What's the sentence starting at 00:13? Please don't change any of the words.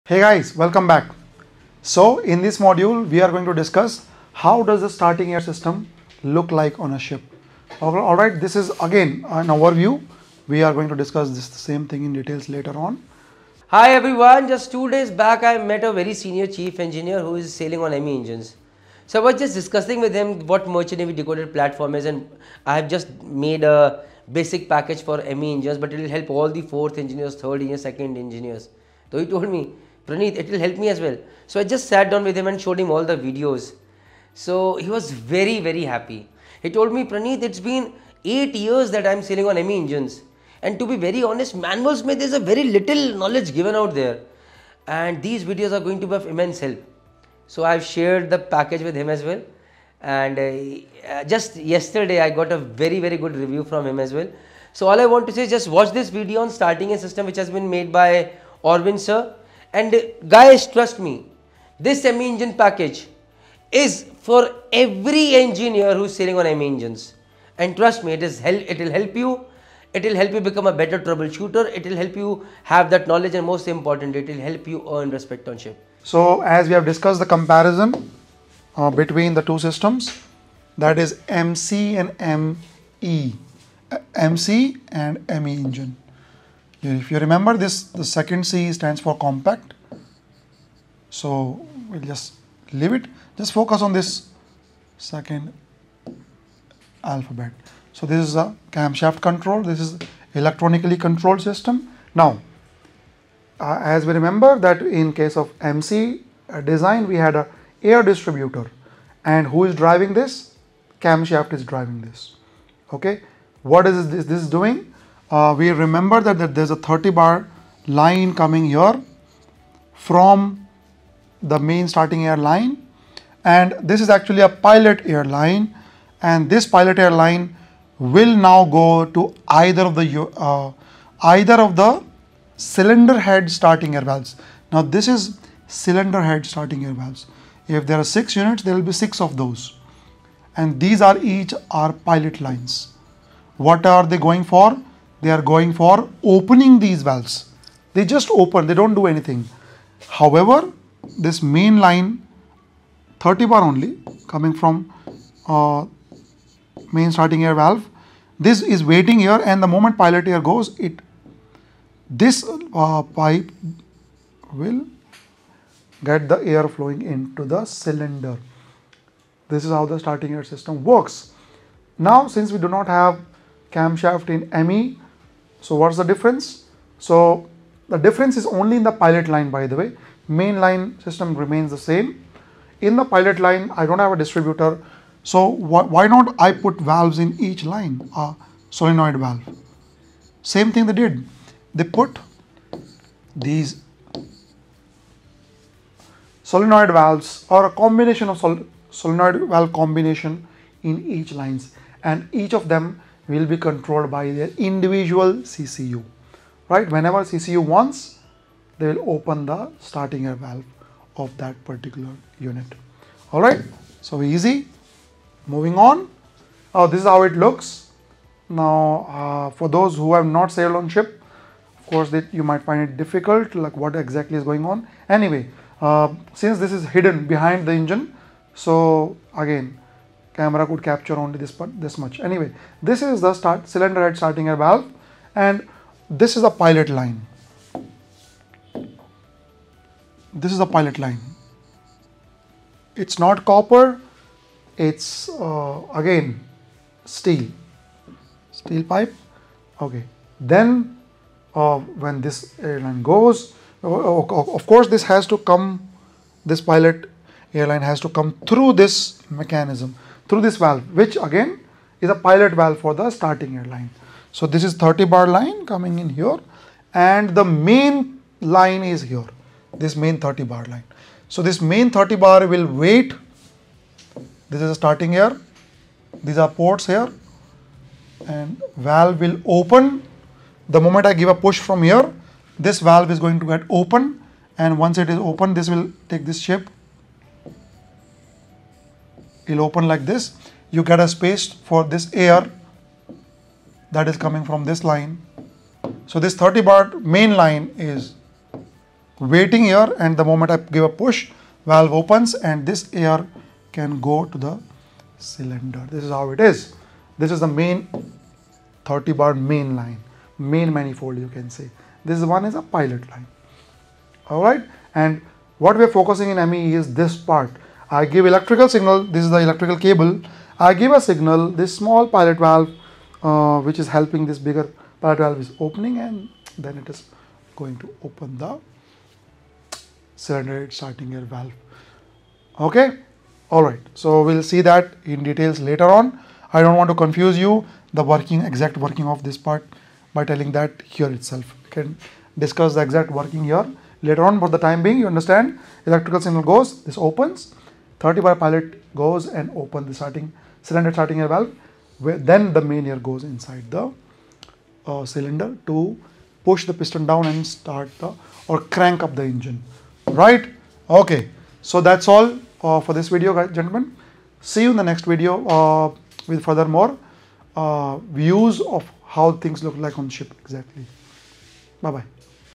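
Hi everyone, just two days back I met a very senior chief engineer who is sailing on ME engines.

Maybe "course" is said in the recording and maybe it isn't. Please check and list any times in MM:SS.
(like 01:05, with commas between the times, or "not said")
03:41, 04:14.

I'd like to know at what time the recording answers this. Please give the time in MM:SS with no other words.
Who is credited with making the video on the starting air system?
00:58.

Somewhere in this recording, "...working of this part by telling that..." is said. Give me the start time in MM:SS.
05:38.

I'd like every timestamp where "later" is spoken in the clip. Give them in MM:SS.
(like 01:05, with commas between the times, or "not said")
00:12, 05:35, 05:44.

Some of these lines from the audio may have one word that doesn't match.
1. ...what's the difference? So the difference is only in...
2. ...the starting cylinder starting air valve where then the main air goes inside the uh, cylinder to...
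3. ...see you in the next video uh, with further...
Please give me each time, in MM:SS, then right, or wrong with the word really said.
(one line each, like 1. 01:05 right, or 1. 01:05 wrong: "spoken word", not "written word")
1. 02:55 right
2. 05:49 right
3. 06:04 right.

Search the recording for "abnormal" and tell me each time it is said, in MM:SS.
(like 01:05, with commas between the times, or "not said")
not said.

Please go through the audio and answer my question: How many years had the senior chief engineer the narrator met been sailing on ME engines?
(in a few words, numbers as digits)
8.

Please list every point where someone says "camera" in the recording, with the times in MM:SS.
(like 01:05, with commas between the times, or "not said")
03:50.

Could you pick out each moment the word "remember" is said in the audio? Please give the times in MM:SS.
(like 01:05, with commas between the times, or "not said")
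01:27, 01:44, 01:55.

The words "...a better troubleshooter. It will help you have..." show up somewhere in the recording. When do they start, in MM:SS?
01:10.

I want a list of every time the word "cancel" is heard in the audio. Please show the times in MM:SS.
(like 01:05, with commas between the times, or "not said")
not said.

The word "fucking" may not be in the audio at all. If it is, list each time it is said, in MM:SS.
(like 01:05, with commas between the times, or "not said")
not said.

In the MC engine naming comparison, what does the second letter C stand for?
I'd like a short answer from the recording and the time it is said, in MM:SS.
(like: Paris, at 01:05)
compact, at 01:29.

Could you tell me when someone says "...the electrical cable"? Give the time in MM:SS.
05:19.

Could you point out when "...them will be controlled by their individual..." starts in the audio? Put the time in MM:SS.
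03:22.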